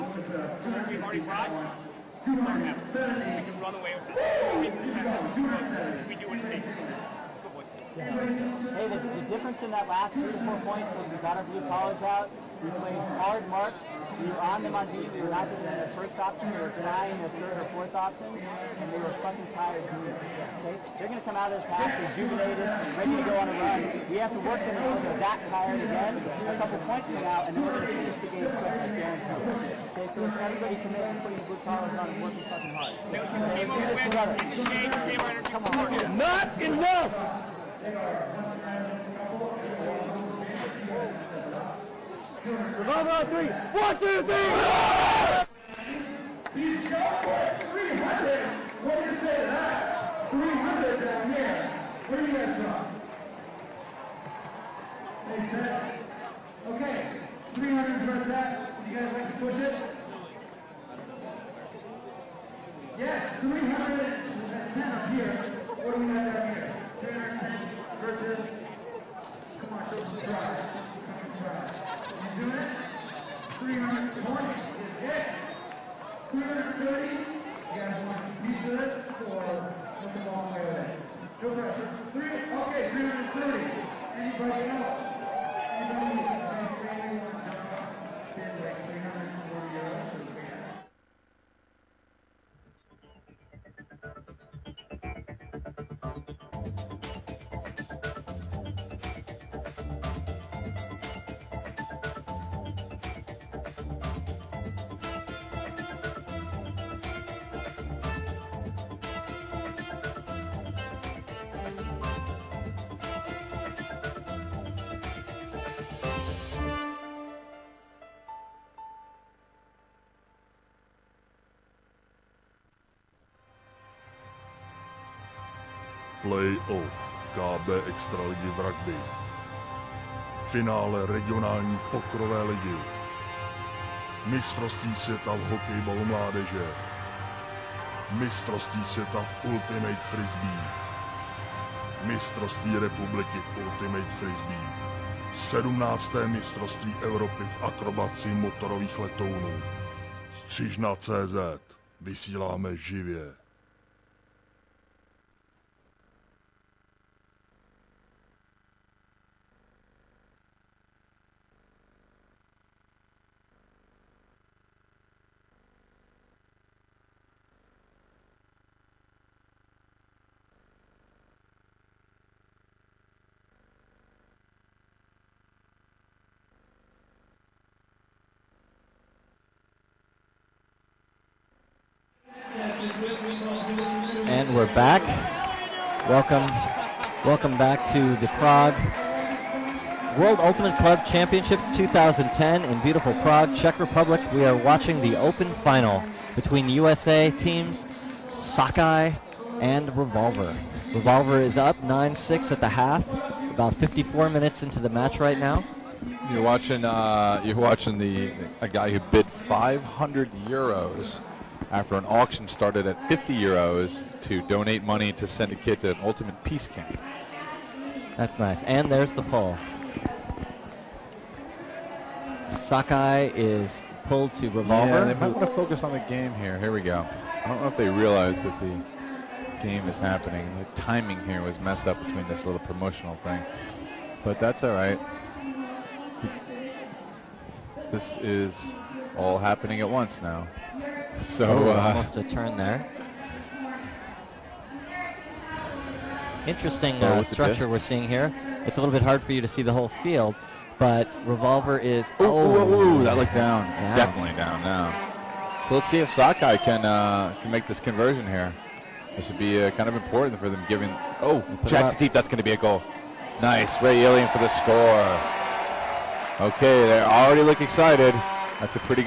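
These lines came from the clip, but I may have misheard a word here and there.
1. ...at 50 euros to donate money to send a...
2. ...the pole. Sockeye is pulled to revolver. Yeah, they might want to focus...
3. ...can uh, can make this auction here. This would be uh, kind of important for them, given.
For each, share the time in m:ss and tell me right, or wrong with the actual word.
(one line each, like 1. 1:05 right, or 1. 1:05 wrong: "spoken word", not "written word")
1. 3:32 right
2. 3:39 right
3. 4:16 wrong: "conversion", not "auction".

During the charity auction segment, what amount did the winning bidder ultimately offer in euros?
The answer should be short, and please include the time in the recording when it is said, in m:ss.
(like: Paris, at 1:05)
500 euros, at 3:29.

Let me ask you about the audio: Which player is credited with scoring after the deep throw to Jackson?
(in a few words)
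Ray Alien.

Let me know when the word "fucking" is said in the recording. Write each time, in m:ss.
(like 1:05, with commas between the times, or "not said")
0:19, 0:32.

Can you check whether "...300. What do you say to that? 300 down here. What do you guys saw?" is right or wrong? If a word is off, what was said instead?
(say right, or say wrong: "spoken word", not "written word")
right.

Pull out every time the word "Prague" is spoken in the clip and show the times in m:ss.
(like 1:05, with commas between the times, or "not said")
3:08, 3:13.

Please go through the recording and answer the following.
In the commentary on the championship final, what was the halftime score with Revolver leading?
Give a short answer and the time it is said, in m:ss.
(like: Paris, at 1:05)
9-6, at 3:21.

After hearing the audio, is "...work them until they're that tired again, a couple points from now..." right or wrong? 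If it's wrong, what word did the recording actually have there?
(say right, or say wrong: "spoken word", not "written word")
right.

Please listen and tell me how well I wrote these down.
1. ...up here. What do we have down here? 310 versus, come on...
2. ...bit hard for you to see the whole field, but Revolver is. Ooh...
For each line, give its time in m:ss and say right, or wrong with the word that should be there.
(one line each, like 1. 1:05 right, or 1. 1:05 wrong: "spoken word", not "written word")
1. 1:04 right
2. 4:08 right.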